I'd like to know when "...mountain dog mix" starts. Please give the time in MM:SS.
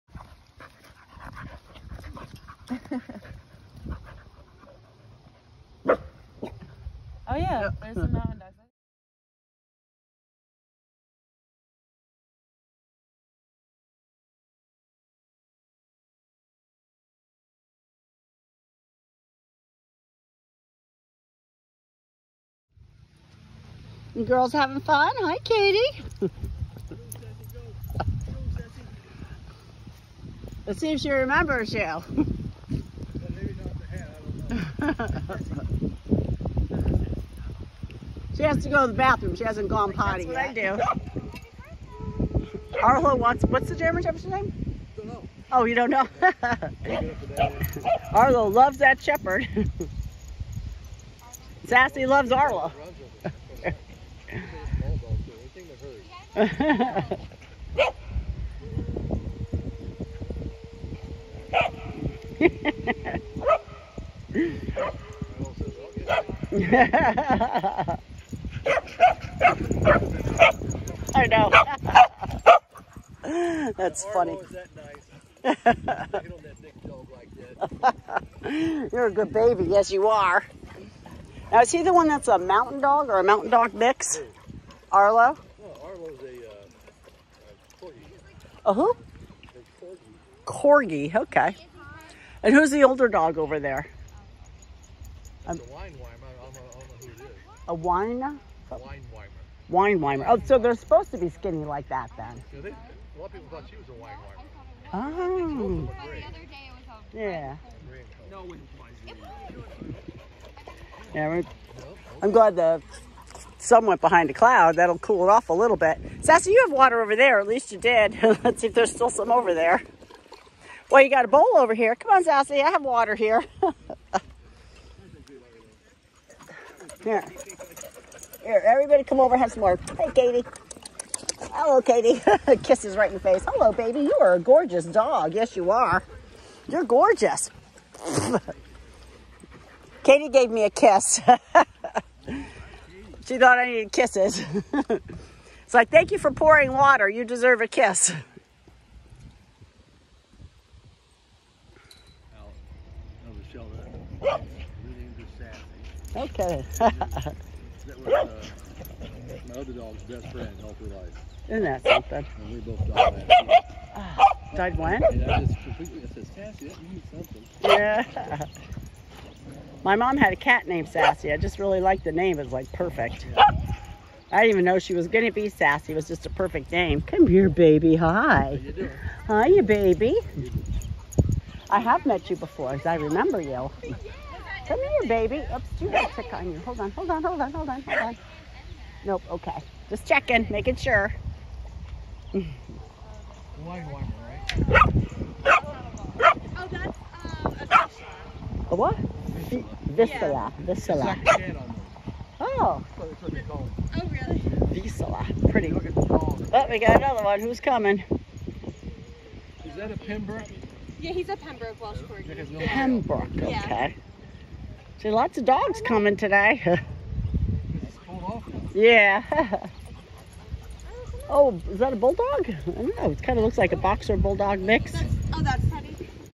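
01:23.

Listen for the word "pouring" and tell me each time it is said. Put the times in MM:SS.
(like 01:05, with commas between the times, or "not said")
02:26.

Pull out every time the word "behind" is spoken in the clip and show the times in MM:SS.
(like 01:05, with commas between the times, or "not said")
01:53.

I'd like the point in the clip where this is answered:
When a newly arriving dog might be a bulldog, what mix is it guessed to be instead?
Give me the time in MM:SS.
03:43.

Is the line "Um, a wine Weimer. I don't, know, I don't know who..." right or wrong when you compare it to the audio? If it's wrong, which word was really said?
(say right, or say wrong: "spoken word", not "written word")
right.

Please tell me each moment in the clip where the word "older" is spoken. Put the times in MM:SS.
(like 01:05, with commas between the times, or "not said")
01:32.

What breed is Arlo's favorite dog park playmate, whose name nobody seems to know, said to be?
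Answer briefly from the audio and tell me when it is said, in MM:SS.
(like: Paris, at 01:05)
German Shepherd, at 00:43.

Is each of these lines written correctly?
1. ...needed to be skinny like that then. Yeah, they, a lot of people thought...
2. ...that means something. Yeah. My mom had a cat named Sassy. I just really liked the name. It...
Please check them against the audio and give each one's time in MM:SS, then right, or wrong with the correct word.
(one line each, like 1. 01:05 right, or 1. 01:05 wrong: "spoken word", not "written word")
1. 01:40 wrong: "supposed", not "needed"
2. 02:46 right.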